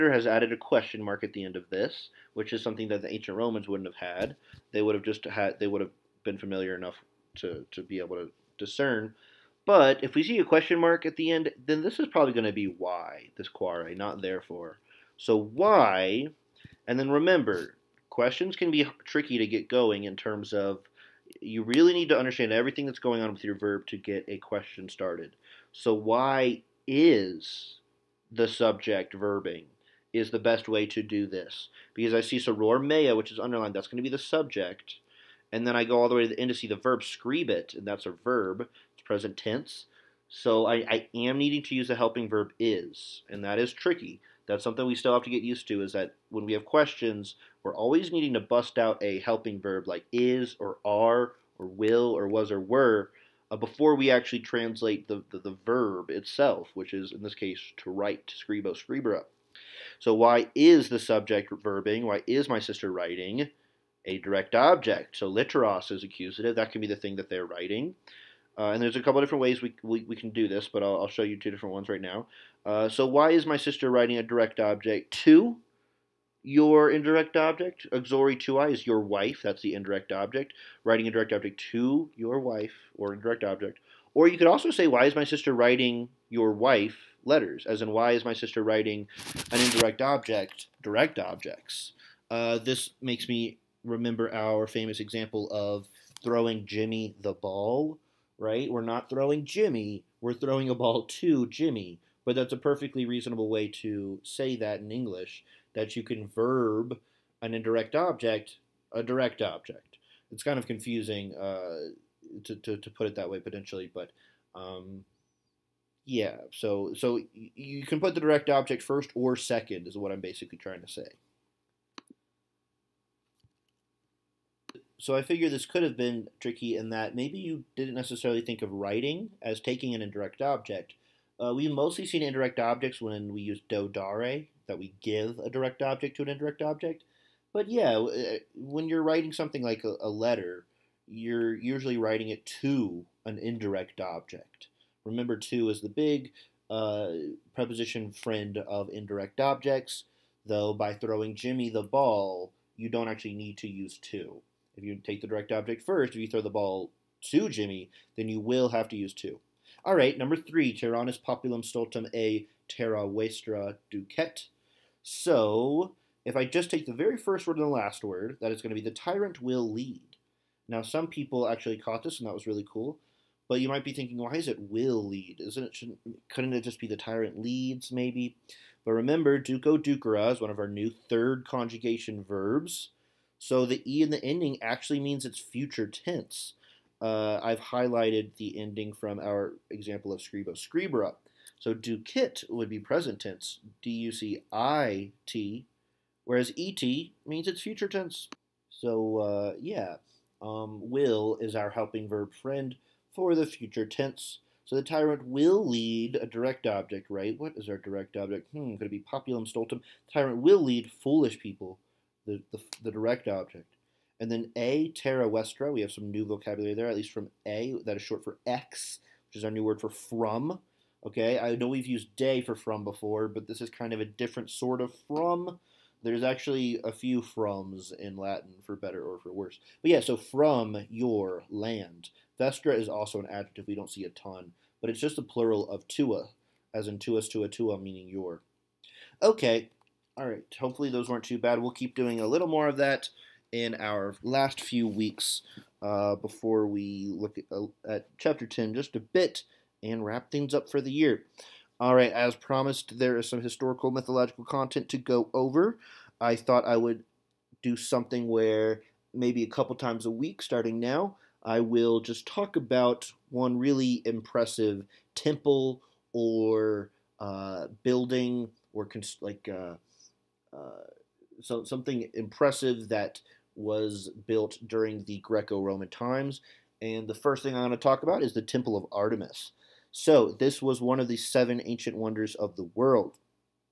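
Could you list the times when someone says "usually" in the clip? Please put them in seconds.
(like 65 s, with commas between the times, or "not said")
141 s.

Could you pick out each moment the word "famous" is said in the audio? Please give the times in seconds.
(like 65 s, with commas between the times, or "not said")
94 s.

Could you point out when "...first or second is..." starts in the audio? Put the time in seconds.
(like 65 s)
118 s.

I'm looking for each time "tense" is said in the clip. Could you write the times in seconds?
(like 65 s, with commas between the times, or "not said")
39 s, 185 s, 193 s, 197 s, 203 s.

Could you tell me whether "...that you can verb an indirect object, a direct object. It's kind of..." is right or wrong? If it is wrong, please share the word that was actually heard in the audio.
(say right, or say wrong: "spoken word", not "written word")
right.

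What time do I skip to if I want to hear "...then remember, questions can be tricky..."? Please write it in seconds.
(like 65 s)
16 s.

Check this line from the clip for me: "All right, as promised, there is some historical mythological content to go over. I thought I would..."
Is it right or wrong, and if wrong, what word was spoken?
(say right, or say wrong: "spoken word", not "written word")
right.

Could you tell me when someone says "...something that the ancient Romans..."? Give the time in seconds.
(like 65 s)
2 s.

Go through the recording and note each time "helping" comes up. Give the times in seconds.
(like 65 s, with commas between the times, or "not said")
41 s, 49 s, 201 s.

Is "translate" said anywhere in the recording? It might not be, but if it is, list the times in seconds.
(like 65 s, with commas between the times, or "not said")
54 s.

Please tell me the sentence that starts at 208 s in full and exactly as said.
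Hmm, could it be populum stultum?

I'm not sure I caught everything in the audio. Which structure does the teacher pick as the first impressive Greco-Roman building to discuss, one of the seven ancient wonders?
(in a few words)
Temple of Artemis.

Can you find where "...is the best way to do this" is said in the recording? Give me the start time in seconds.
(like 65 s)
30 s.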